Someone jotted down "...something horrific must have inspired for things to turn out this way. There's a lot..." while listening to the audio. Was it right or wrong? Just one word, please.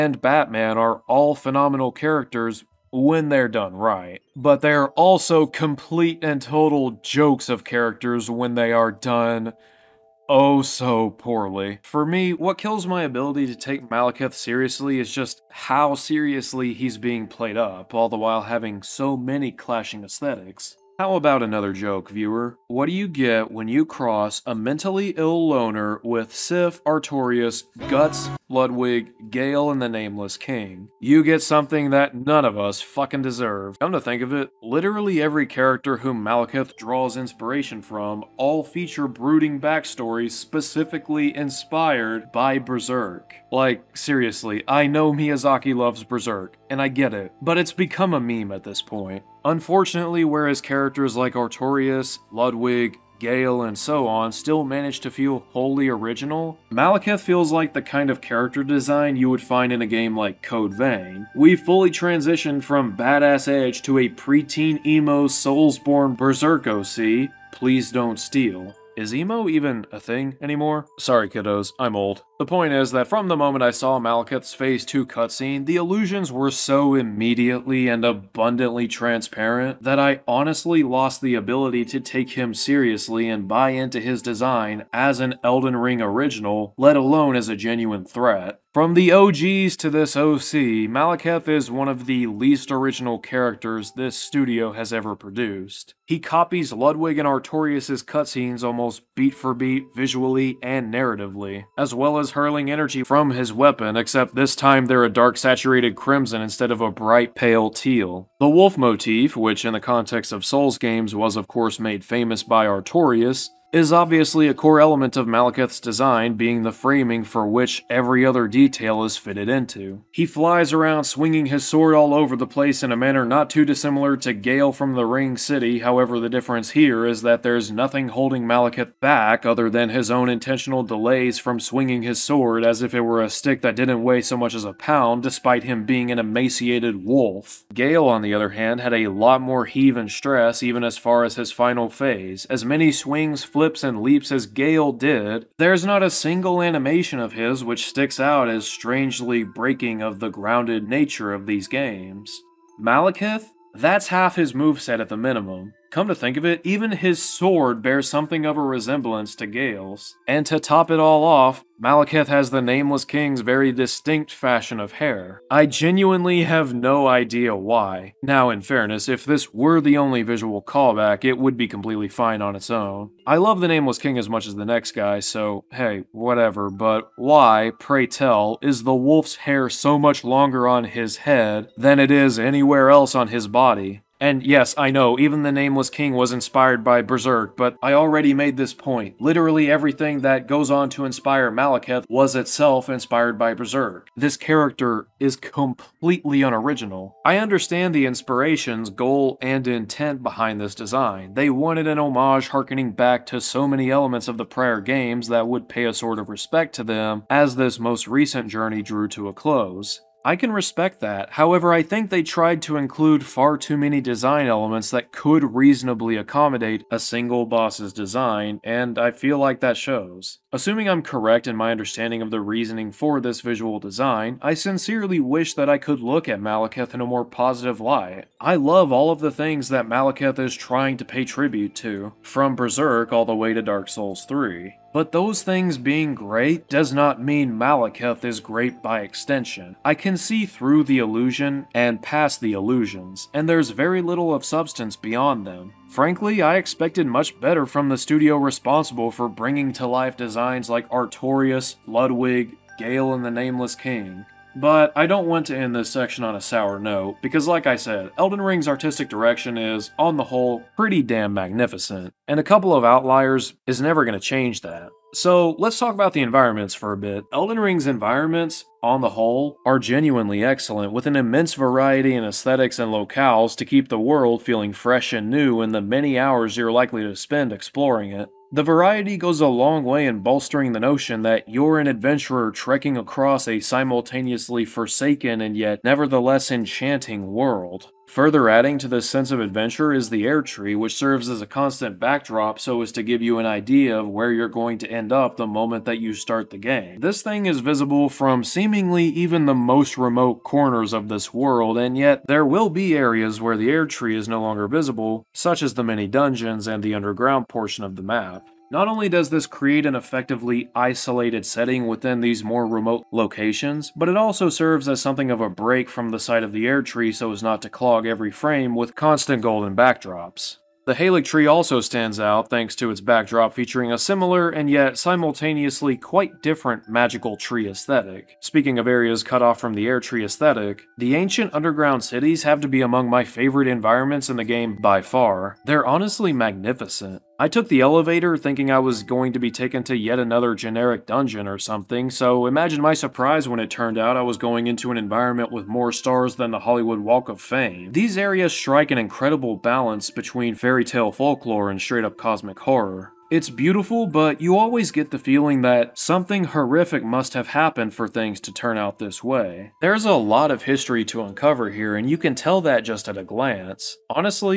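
wrong.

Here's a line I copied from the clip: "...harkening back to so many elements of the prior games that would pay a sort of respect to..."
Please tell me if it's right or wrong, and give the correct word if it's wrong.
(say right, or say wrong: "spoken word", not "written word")
right.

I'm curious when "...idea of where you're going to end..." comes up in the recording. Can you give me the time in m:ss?
4:53.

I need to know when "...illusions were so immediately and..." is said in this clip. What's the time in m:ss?
1:15.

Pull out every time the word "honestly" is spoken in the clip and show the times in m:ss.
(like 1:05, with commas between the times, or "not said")
1:20, 5:35.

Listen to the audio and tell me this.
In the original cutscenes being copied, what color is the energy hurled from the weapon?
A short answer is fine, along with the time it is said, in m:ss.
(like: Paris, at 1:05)
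bright pale teal, at 1:46.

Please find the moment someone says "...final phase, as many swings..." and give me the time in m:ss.
2:21.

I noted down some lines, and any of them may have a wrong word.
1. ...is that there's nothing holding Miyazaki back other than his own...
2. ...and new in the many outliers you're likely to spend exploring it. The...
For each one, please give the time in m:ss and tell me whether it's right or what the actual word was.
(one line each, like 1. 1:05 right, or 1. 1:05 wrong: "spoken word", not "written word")
1. 2:07 wrong: "Maliketh", not "Miyazaki"
2. 4:35 wrong: "hours", not "outliers".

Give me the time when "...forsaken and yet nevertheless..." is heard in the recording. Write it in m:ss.
4:44.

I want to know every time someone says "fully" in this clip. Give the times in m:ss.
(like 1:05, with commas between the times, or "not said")
1:01.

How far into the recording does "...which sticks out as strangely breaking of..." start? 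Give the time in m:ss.
2:27.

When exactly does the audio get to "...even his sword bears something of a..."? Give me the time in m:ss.
2:36.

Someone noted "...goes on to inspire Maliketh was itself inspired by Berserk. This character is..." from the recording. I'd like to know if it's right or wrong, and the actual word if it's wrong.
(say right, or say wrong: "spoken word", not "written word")
right.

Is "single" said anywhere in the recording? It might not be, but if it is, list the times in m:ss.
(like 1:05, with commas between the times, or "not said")
2:26, 3:37.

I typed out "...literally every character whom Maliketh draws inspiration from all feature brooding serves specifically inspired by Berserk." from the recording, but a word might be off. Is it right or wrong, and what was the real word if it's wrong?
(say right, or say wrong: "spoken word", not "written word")
wrong: "backstories", not "serves".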